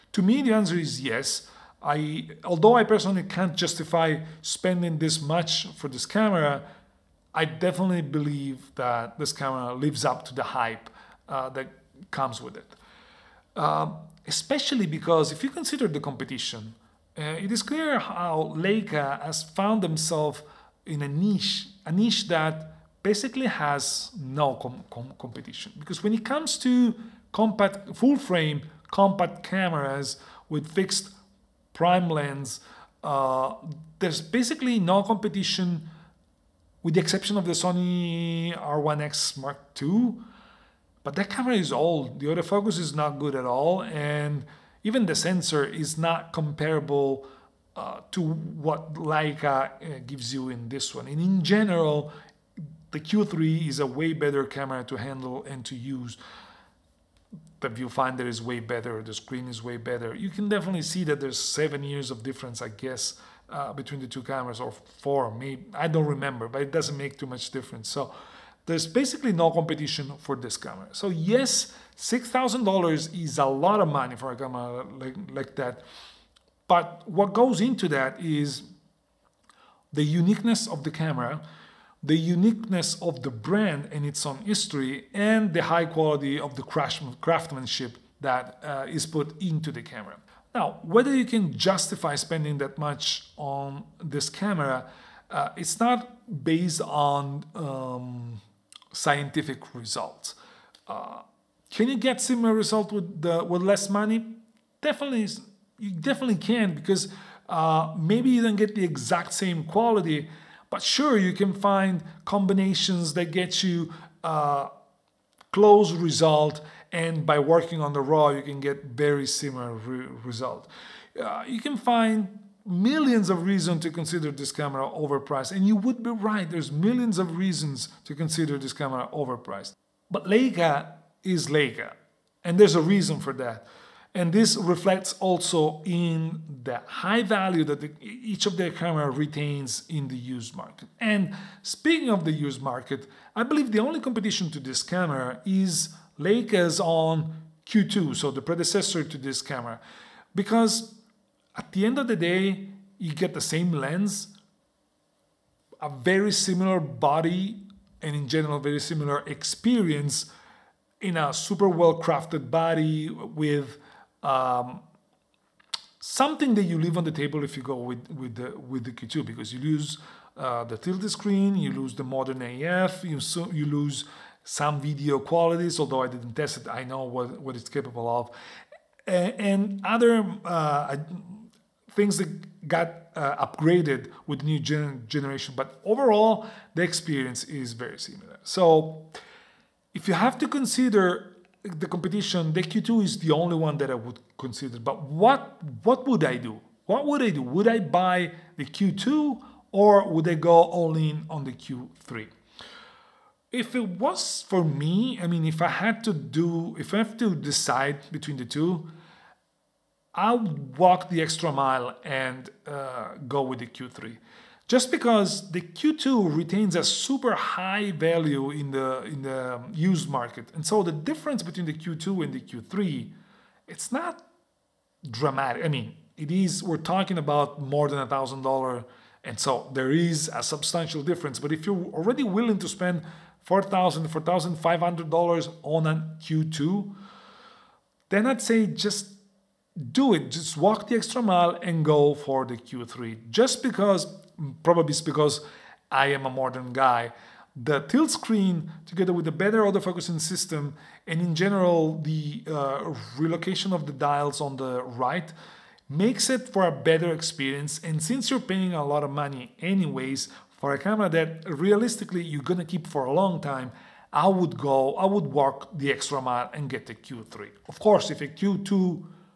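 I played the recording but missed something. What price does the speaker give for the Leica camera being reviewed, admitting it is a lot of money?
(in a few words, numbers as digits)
$6,000.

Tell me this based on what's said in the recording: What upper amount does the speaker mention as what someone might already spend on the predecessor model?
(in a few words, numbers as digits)
$4,500.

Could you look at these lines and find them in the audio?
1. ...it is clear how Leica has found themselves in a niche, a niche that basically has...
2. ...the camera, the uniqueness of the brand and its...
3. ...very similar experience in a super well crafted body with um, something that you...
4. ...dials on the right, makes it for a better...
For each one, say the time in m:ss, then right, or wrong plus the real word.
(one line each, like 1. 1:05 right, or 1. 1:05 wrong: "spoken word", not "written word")
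1. 0:17 right
2. 1:20 right
3. 2:38 right
4. 4:13 right.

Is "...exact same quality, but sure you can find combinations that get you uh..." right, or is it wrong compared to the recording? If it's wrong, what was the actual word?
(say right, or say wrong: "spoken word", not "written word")
right.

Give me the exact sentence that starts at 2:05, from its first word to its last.
And you would be right, there's millions of reasons to consider this camera overpriced.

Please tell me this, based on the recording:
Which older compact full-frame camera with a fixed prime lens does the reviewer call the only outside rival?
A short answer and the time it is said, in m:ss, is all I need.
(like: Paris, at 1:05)
Sony R1X Mark II, at 0:37.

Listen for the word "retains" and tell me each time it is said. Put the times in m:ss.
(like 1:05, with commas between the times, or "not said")
2:19, 3:36.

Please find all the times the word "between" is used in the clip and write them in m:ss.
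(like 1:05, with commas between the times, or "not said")
1:03, 3:28, 3:41.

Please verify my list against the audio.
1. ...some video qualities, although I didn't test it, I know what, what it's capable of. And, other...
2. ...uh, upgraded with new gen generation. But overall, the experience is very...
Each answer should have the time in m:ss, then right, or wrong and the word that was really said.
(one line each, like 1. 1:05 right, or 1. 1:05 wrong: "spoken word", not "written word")
1. 2:54 right
2. 3:03 right.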